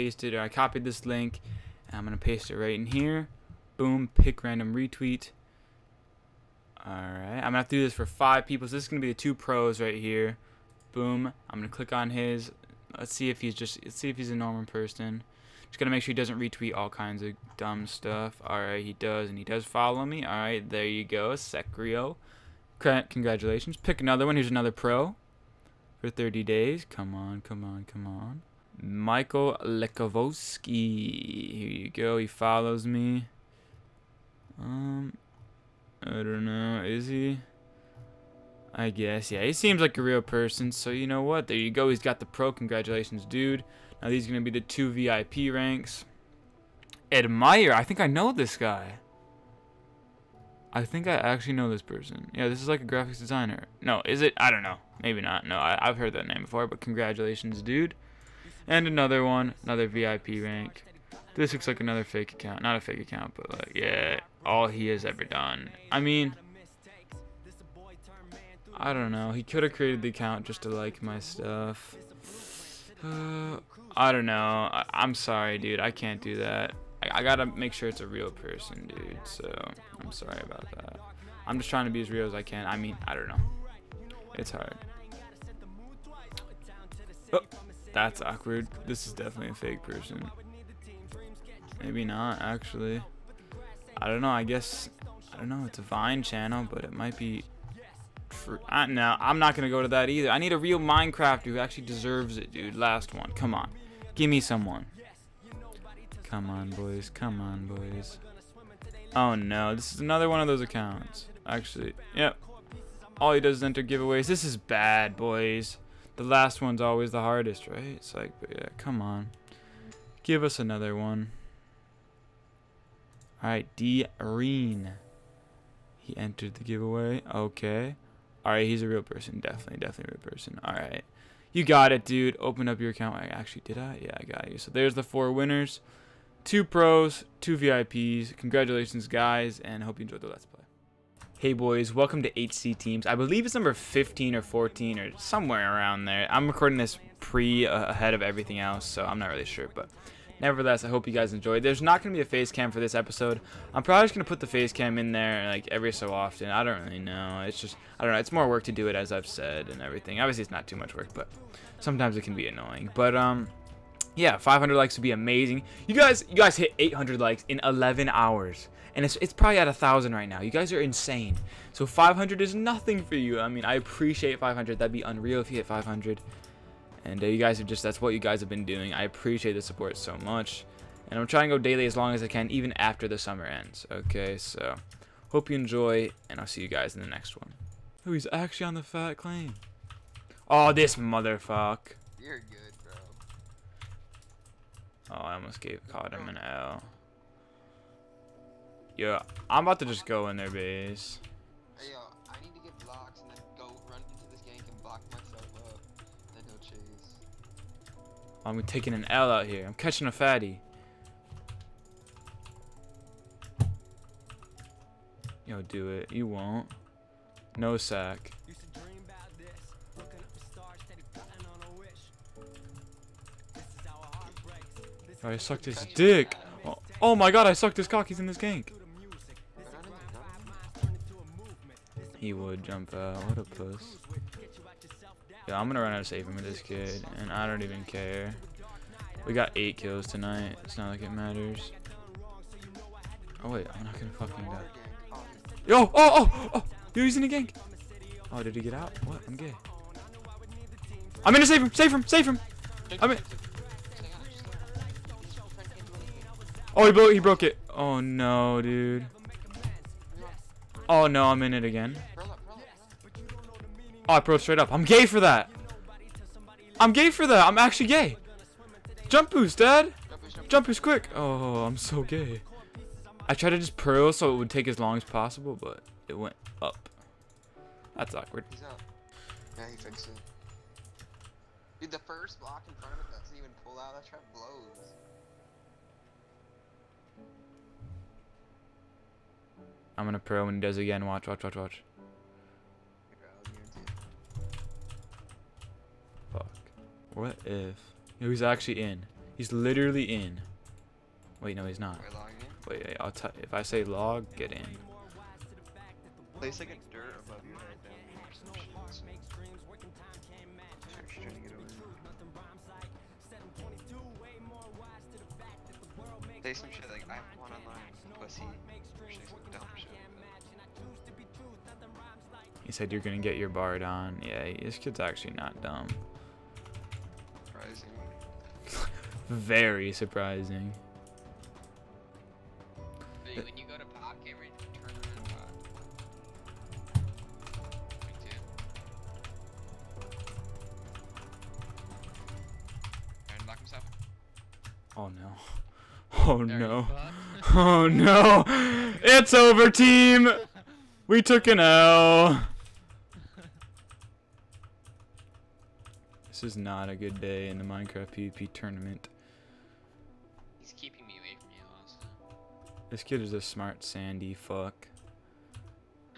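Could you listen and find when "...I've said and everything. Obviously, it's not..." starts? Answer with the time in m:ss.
2:39.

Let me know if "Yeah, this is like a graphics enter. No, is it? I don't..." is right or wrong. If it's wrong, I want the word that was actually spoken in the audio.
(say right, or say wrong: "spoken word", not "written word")
wrong: "designer", not "enter".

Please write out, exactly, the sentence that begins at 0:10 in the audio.
Boom, I'm going to click on his.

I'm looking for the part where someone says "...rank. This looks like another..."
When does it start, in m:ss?
1:00.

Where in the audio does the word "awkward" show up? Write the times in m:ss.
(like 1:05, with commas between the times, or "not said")
1:28, 4:38.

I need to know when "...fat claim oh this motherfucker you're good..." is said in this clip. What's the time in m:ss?
3:08.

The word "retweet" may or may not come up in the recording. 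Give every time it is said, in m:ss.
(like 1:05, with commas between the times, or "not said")
0:04, 0:16.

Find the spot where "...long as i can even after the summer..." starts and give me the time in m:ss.
3:01.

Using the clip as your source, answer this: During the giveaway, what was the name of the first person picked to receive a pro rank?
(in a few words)
Secrio.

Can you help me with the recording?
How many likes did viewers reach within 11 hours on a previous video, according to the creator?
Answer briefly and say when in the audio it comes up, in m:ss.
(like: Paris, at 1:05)
800, at 2:46.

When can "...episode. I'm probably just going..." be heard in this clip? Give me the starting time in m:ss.
2:32.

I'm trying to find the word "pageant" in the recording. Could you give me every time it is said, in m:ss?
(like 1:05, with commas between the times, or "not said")
not said.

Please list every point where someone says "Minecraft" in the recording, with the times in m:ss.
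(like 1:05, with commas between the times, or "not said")
1:40, 5:57.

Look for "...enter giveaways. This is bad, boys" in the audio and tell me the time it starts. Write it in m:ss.
1:53.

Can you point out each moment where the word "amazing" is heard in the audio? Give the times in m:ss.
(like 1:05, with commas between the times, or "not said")
2:45.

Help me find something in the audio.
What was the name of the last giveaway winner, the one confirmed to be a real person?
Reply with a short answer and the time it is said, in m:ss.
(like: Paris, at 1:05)
D. Reen, at 2:03.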